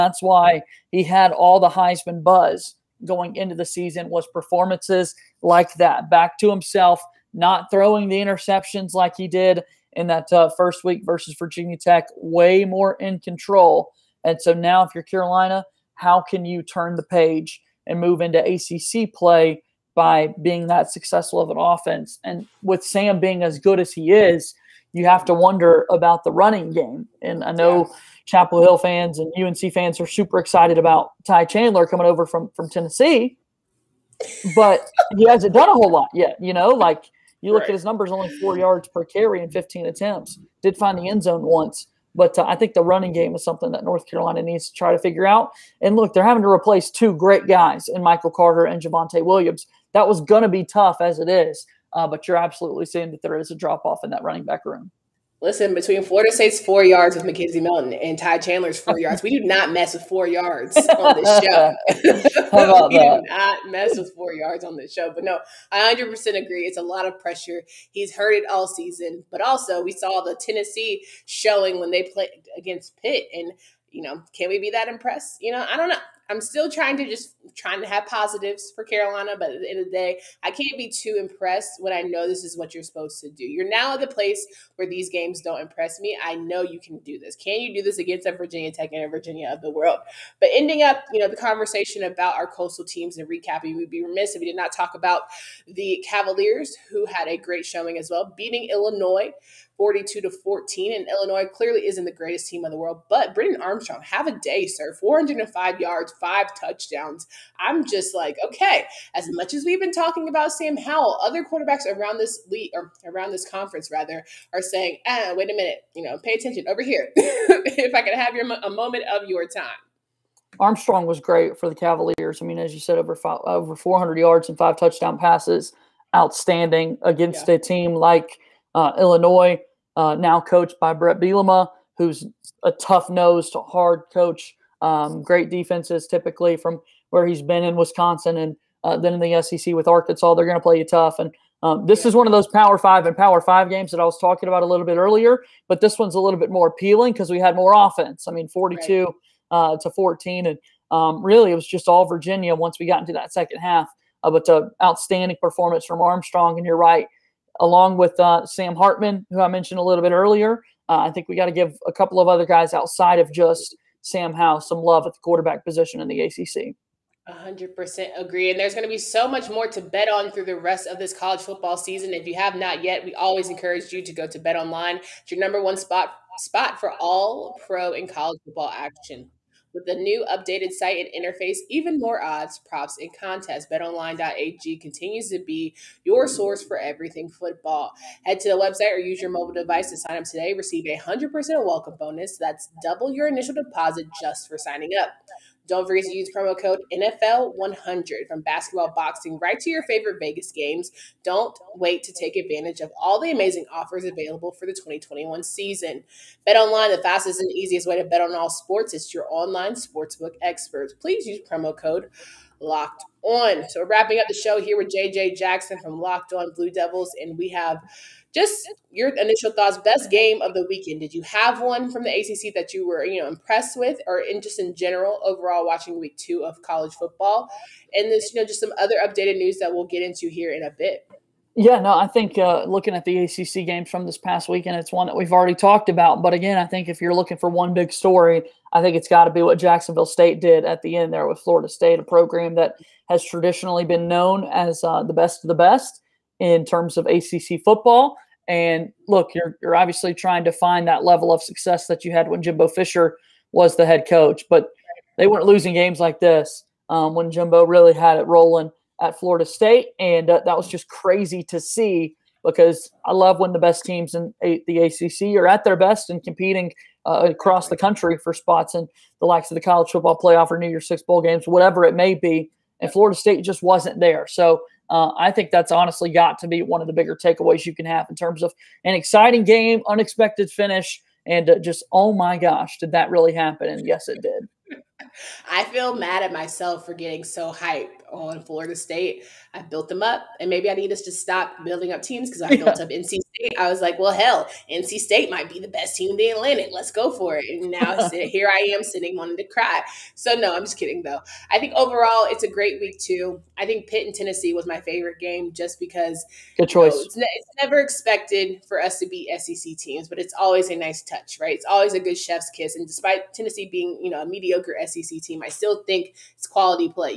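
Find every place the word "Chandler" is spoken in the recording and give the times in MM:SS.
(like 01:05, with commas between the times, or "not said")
00:31, 00:58.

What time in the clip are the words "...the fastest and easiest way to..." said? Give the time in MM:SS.
03:26.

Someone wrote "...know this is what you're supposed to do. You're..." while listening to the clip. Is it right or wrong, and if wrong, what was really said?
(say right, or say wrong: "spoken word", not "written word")
right.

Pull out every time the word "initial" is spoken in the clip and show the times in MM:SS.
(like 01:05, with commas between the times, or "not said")
03:13, 03:39.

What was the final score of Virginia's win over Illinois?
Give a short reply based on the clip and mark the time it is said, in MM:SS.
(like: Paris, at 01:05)
42 to 14, at 01:39.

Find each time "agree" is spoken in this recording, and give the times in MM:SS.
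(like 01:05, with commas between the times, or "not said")
01:06, 02:48.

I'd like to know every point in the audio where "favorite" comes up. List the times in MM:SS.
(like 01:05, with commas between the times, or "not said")
03:19, 05:04.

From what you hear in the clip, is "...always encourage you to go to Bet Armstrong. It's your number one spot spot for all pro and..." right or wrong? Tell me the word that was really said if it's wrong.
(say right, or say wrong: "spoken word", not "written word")
wrong: "Online", not "Armstrong".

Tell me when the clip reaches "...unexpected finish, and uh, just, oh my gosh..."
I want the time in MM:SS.
04:39.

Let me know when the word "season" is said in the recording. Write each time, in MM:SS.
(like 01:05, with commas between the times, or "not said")
00:03, 01:08, 02:51, 03:25.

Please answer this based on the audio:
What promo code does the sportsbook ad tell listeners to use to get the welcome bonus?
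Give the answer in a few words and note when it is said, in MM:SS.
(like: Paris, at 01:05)
NFL100, at 03:16.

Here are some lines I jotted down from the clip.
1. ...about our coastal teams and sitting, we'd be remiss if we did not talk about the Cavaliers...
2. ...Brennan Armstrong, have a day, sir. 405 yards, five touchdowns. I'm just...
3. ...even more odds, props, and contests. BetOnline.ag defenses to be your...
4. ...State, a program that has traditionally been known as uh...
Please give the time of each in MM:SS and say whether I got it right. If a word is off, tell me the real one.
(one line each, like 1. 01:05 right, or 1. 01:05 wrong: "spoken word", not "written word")
1. 01:32 wrong: "recapping", not "sitting"
2. 01:43 right
3. 03:01 wrong: "continues", not "defenses"
4. 04:01 right.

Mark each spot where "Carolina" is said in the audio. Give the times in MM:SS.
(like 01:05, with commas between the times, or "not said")
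00:15, 00:44, 01:18.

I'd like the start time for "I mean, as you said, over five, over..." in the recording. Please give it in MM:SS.
02:02.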